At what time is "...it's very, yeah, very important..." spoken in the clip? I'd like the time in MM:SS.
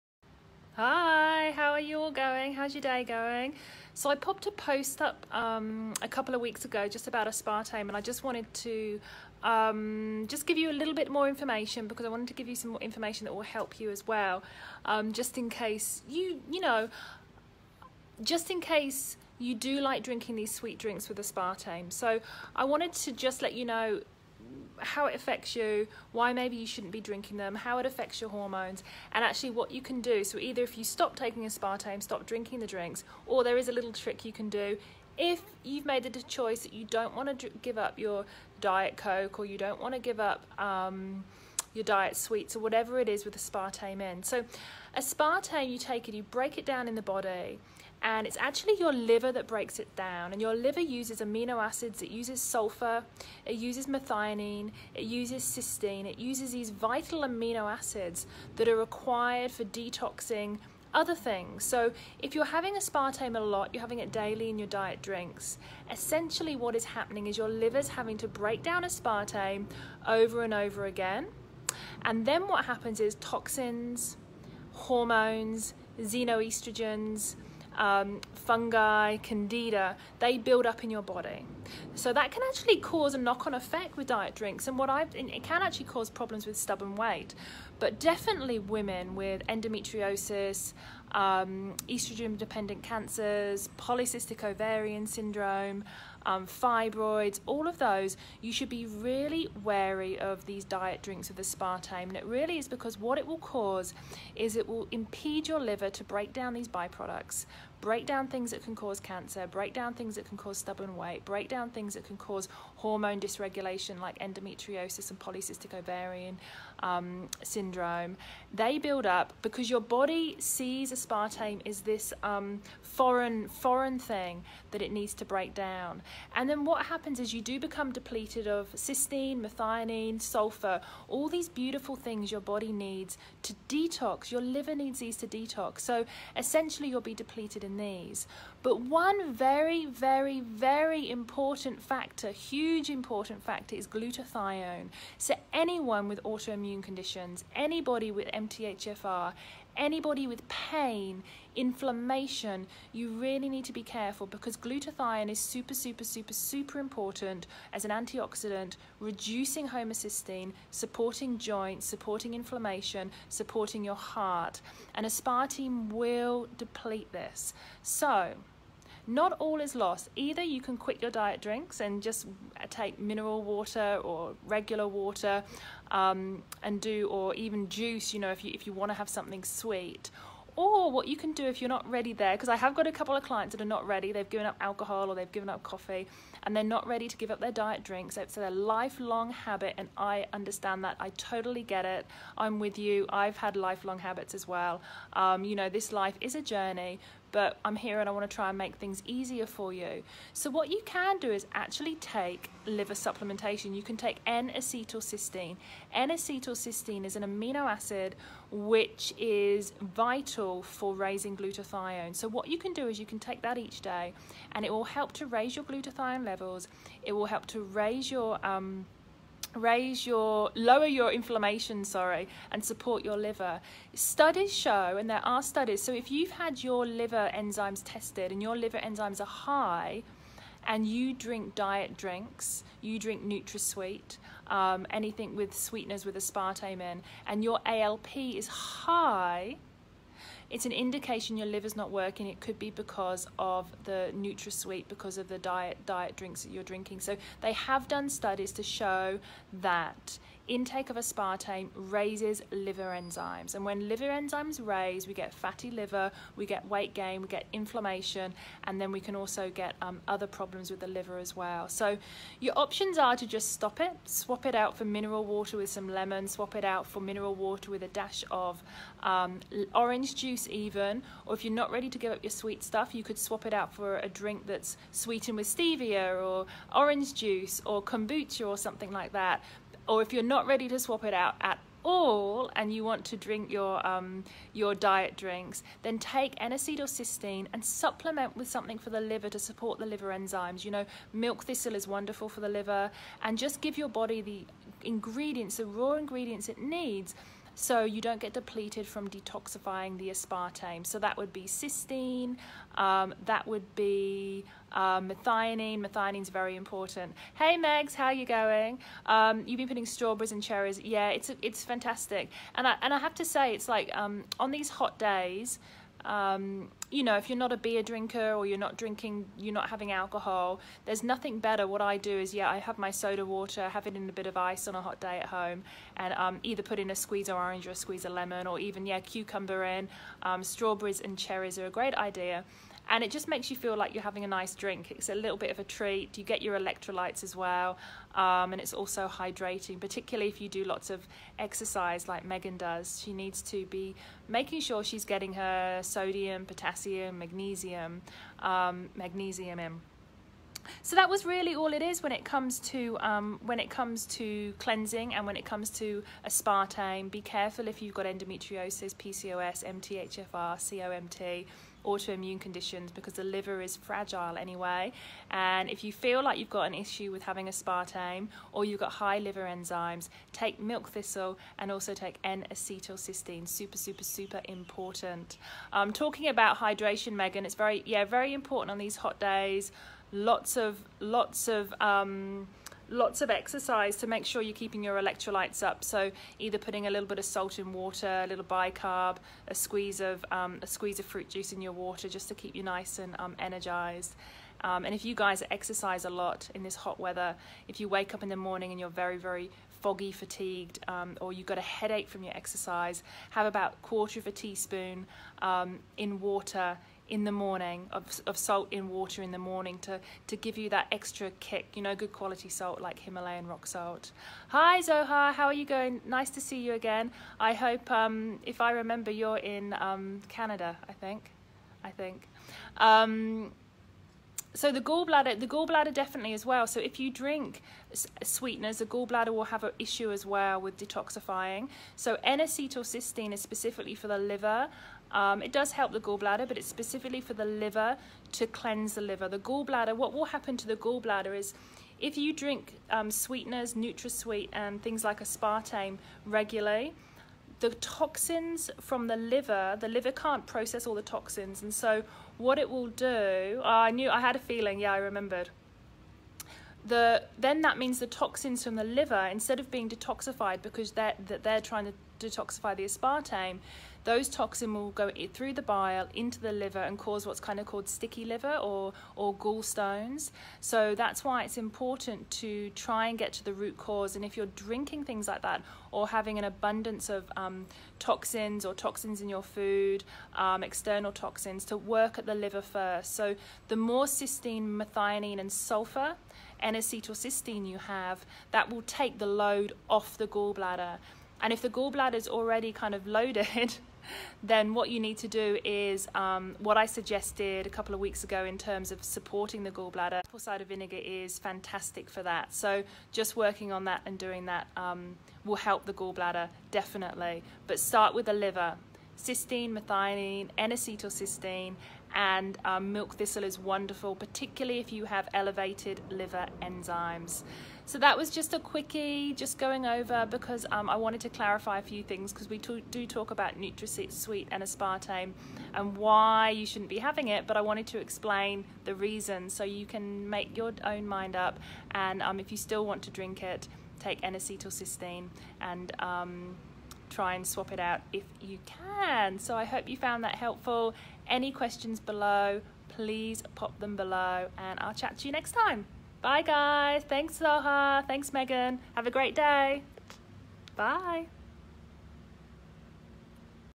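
06:17.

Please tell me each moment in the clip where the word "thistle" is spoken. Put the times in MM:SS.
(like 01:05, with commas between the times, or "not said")
04:51, 06:10, 08:33.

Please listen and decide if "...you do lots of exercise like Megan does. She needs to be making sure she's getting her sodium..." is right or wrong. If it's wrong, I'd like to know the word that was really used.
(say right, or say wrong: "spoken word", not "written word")
right.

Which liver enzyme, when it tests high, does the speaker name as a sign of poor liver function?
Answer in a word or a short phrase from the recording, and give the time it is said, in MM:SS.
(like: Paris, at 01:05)
ALP, at 03:57.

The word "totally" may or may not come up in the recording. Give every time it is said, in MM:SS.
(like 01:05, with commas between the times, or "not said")
03:11.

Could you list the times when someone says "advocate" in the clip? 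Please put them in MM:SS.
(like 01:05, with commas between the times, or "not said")
not said.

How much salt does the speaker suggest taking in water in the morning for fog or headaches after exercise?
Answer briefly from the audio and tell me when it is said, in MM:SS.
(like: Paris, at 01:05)
Quarter of a teaspoon, at 06:43.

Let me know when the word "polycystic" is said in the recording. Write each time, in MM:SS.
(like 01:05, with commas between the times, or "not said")
01:33, 01:55.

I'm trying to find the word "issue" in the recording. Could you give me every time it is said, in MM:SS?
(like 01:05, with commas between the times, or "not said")
06:06, 07:09.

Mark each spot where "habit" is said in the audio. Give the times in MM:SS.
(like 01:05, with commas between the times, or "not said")
03:09, 03:13.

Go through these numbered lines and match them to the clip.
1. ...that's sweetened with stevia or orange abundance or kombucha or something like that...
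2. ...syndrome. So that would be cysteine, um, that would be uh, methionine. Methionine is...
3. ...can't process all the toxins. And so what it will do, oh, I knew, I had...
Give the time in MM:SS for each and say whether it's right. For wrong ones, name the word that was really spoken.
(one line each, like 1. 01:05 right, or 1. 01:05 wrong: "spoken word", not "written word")
1. 04:34 wrong: "juice", not "abundance"
2. 05:00 wrong: "aspartame", not "syndrome"
3. 07:30 right.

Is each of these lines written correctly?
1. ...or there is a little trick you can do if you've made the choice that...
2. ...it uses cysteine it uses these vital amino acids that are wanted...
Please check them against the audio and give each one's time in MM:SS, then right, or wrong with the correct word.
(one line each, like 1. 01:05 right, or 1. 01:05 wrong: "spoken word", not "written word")
1. 00:33 right
2. 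00:54 wrong: "required", not "wanted".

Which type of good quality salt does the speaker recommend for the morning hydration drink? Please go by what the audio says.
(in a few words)
Himalayan rock salt.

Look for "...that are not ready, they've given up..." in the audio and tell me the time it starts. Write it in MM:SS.
03:03.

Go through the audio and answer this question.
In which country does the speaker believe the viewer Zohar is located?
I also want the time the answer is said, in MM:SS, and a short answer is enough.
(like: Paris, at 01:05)
Canada, at 07:00.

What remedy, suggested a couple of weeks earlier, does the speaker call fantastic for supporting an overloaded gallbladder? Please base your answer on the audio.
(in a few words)
Apple cider vinegar.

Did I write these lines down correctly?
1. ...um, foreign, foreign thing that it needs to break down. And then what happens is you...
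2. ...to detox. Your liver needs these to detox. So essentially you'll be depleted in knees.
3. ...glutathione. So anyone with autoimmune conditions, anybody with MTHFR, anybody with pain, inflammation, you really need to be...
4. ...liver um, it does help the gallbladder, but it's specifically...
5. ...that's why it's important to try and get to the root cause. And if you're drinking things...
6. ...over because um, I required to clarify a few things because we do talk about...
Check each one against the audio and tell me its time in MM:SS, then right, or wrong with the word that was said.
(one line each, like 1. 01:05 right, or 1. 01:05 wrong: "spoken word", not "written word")
1. 02:02 right
2. 02:13 right
3. 02:23 right
4. 07:14 right
5. 07:50 right
6. 08:39 wrong: "wanted", not "required".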